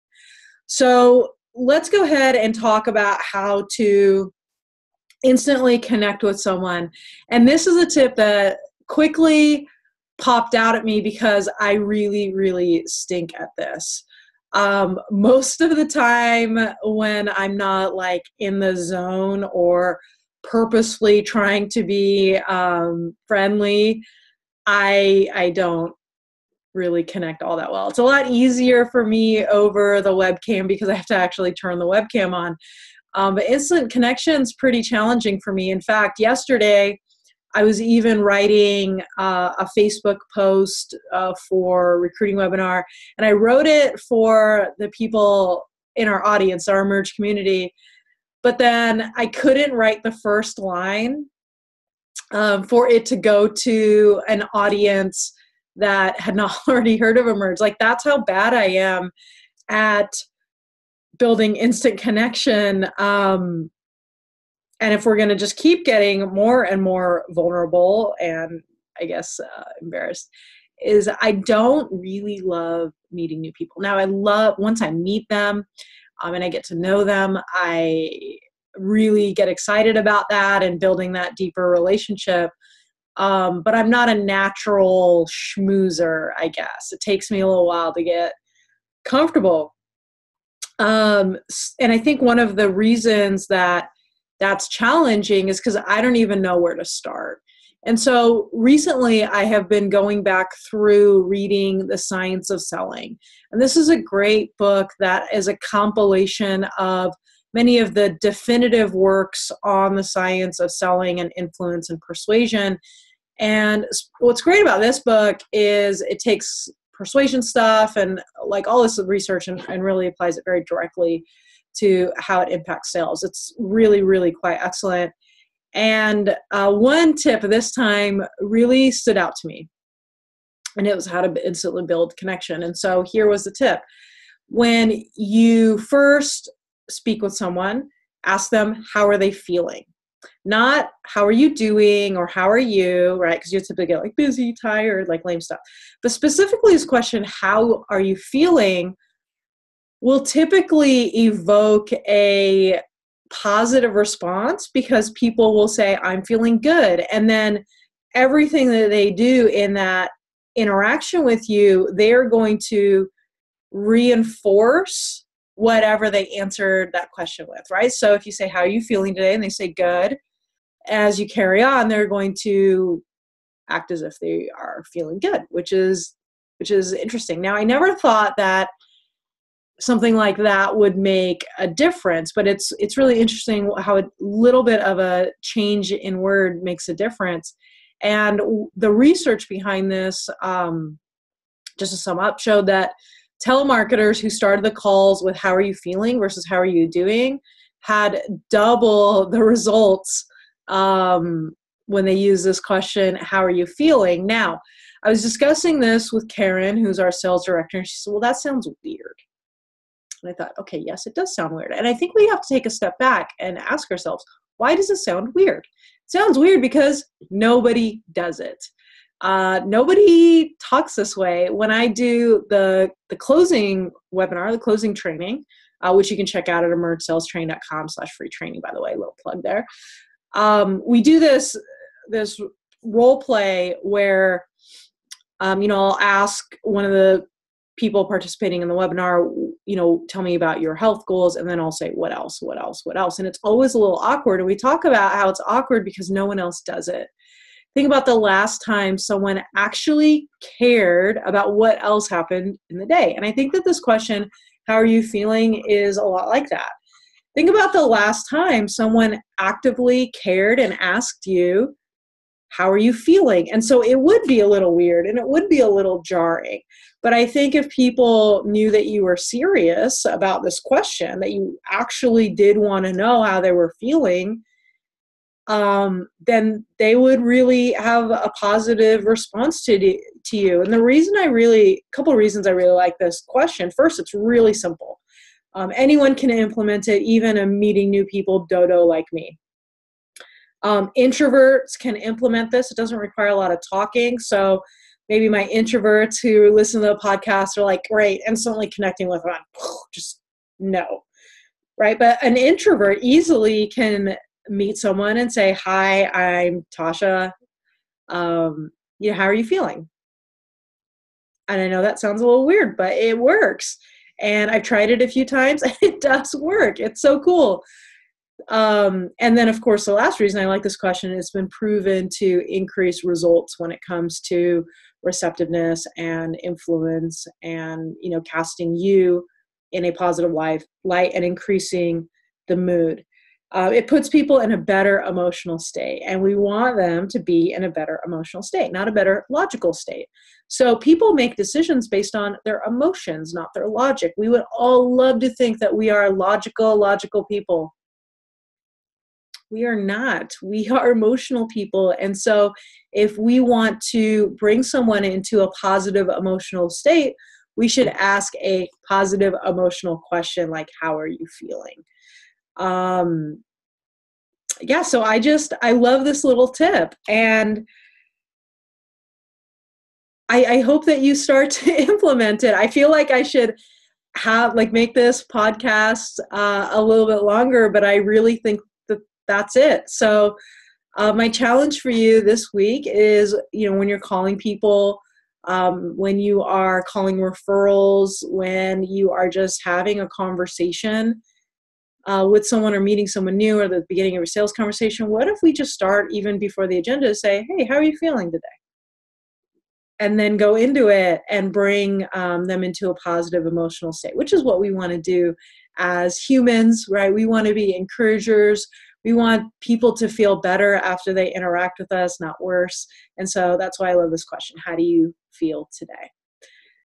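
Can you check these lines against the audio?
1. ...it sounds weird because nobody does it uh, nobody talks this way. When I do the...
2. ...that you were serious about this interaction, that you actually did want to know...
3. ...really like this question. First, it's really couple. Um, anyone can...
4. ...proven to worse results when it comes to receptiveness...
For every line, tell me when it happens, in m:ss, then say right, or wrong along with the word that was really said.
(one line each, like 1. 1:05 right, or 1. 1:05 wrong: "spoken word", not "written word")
1. 3:36 right
2. 4:28 wrong: "question", not "interaction"
3. 4:42 wrong: "simple", not "couple"
4. 5:21 wrong: "increase", not "worse".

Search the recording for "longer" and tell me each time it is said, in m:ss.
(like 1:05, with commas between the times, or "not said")
6:17.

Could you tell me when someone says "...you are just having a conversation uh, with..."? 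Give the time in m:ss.
6:28.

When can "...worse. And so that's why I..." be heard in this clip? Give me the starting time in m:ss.
6:52.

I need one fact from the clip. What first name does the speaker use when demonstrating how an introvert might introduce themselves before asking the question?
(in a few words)
Tasha.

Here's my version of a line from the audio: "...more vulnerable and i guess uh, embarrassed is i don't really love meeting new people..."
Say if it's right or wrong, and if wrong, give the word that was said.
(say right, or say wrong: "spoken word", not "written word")
right.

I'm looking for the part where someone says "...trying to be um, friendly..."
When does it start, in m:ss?
0:21.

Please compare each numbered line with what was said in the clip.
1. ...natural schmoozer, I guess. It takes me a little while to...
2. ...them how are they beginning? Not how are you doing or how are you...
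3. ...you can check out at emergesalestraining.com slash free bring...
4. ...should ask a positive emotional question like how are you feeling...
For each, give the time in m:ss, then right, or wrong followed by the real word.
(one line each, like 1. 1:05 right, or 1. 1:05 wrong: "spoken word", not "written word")
1. 1:24 right
2. 2:18 wrong: "feeling", not "beginning"
3. 3:46 wrong: "training", not "bring"
4. 5:57 right.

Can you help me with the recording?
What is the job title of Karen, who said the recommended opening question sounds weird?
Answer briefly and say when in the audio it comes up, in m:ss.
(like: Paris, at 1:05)
Sales director, at 3:27.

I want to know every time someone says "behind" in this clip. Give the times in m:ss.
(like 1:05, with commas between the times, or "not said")
3:09.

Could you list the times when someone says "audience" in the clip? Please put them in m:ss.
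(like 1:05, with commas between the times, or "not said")
0:46, 0:54.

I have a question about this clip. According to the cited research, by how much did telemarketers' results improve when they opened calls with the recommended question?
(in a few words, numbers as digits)
Double.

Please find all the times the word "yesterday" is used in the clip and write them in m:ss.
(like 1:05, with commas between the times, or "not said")
0:36.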